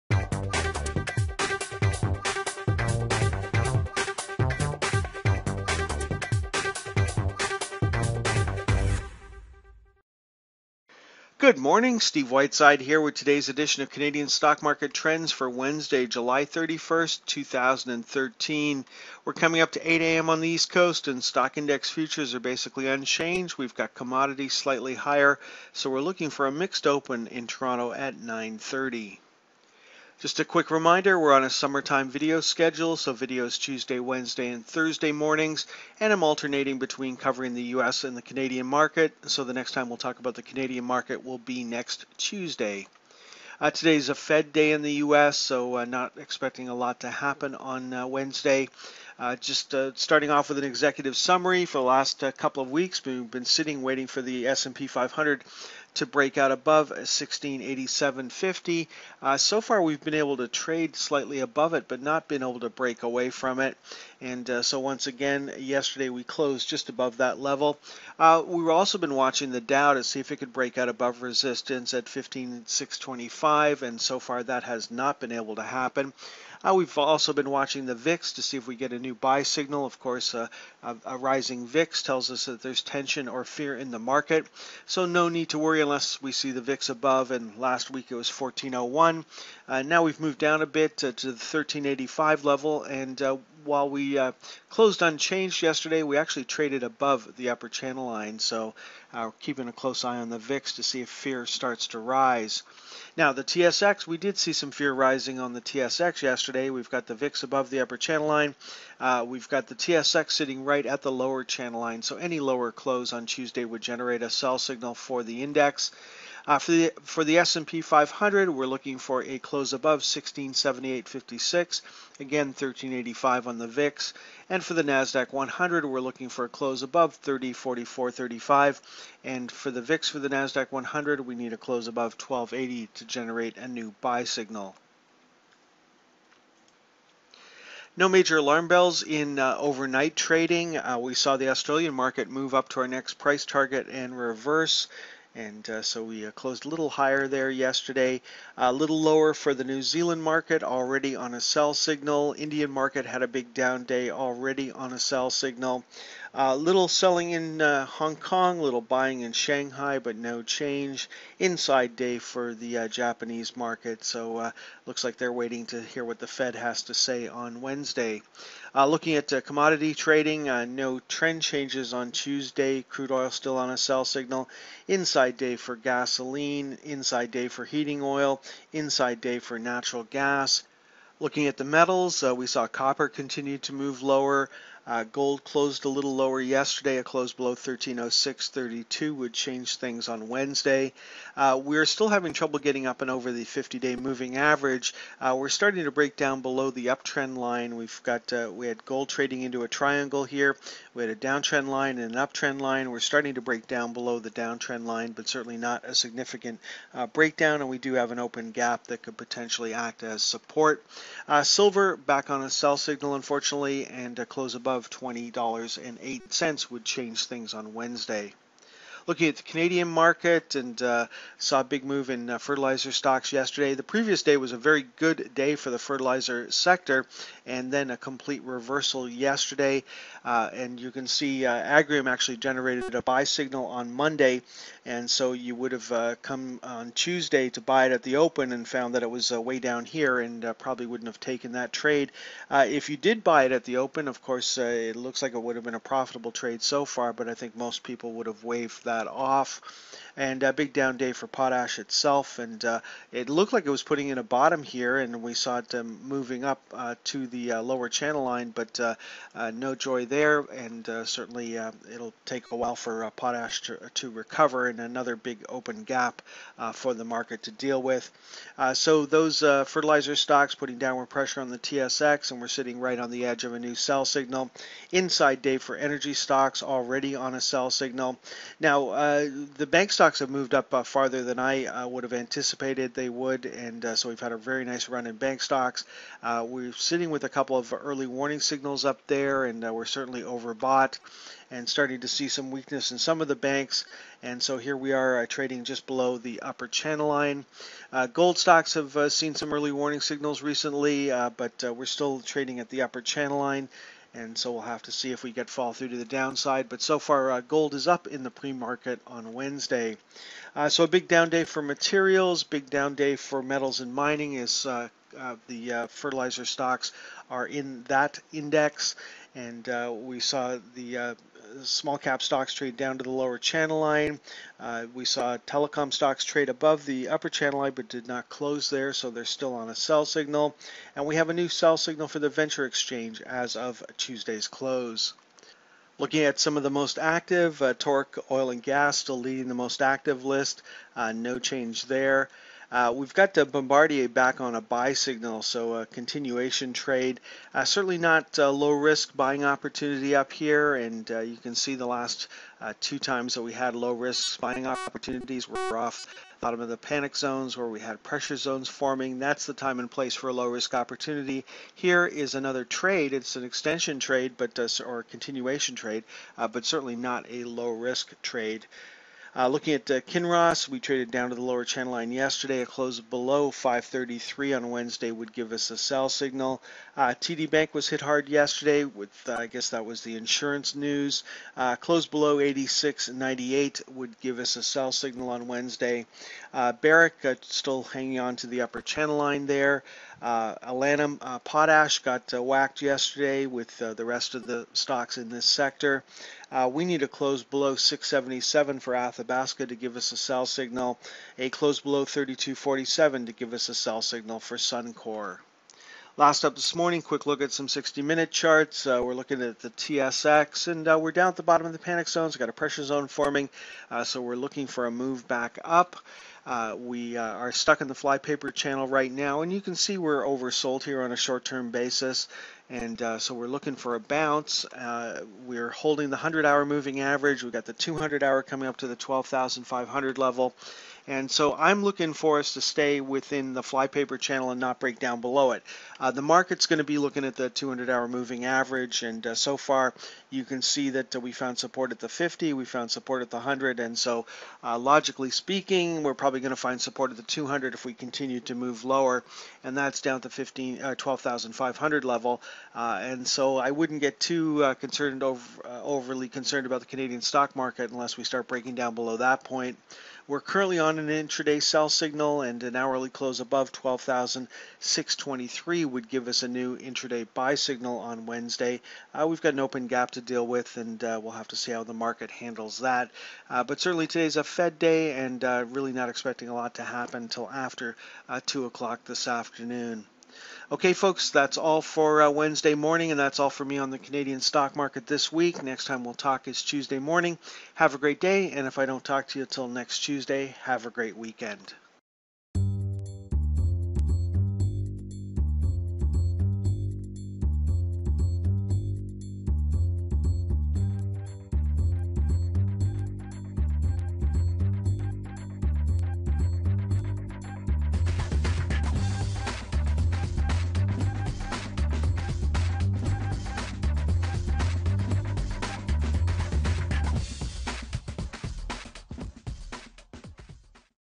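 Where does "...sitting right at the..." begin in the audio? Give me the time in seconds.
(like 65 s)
110 s.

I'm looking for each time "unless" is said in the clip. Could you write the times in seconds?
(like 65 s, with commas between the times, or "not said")
85 s, 457 s.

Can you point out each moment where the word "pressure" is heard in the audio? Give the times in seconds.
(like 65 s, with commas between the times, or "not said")
271 s, 358 s, 412 s.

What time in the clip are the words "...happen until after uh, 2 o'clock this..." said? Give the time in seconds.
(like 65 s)
476 s.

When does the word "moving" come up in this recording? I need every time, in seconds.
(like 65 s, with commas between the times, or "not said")
193 s, 256 s, 426 s, 438 s.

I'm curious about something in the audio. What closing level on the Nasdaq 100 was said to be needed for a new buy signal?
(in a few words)
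3044.35.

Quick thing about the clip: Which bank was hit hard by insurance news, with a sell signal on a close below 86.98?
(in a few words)
TD Bank.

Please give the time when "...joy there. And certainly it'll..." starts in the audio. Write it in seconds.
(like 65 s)
259 s.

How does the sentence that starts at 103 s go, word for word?
Now, the TSX, we did see some fear rising on the TSX yesterday.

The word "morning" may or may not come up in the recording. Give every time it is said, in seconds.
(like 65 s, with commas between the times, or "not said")
11 s, 35 s, 406 s, 482 s, 486 s.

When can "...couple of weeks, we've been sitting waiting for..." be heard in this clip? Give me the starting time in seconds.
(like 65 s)
52 s.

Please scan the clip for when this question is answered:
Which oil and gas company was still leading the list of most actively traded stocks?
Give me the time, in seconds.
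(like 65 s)
337 s.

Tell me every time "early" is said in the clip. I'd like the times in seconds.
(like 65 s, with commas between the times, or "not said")
287 s, 299 s.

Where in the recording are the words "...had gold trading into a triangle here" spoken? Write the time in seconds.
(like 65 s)
198 s.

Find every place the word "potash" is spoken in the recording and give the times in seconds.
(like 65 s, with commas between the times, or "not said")
251 s, 263 s, 391 s.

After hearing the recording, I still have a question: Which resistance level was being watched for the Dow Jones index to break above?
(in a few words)
15625.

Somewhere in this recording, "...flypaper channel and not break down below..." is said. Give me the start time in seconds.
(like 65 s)
433 s.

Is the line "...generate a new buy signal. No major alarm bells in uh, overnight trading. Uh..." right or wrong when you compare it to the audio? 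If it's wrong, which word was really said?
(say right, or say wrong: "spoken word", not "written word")
right.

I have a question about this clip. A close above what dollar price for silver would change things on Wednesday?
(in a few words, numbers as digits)
$20.08.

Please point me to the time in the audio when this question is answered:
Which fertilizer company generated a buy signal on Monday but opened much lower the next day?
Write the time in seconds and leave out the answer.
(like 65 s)
231 s.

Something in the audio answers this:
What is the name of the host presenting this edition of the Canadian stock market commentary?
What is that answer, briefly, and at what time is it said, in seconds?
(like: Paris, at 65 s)
Steve Whiteside, at 11 s.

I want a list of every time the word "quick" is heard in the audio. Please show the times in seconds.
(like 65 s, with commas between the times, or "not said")
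30 s, 407 s.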